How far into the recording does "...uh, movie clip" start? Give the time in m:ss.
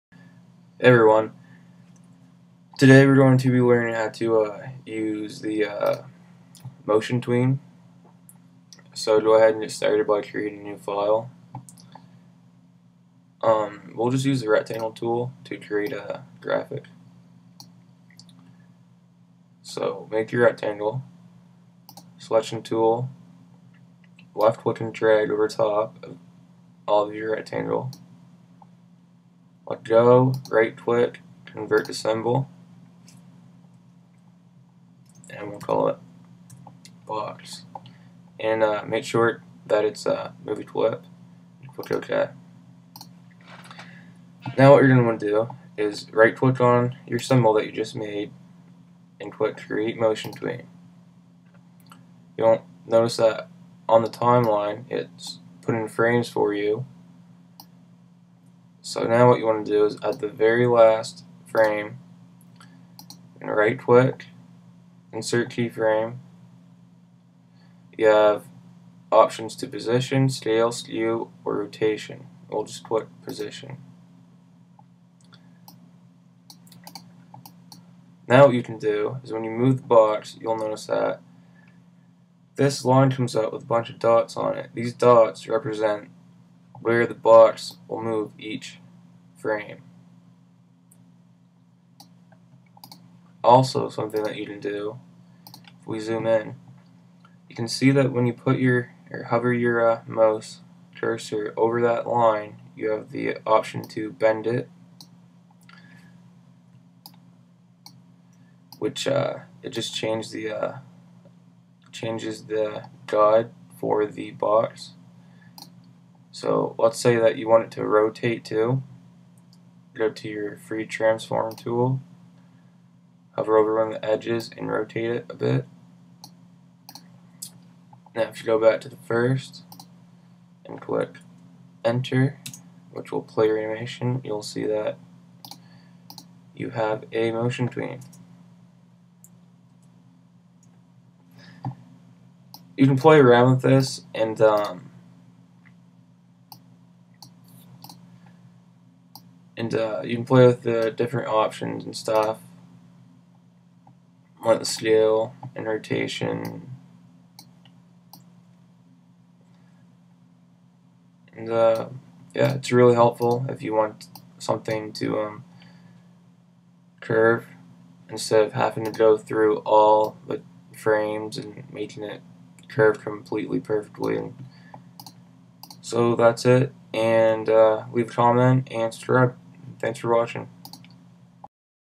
0:40.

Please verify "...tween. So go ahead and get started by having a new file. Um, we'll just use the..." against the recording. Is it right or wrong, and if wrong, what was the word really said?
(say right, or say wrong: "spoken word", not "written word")
wrong: "creating", not "having".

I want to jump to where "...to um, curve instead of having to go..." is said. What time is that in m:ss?
2:44.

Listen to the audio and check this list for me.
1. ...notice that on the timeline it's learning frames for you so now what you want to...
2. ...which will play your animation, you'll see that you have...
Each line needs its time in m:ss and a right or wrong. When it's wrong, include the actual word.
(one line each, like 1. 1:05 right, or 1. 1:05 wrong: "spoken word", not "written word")
1. 0:52 wrong: "putting", not "learning"
2. 2:12 right.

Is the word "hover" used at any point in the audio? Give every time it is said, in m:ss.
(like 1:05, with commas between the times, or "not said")
1:39, 2:03.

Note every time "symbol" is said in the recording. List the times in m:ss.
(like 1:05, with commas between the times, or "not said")
0:31, 0:47.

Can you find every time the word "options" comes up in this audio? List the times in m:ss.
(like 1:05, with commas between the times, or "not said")
1:09, 1:43, 2:31.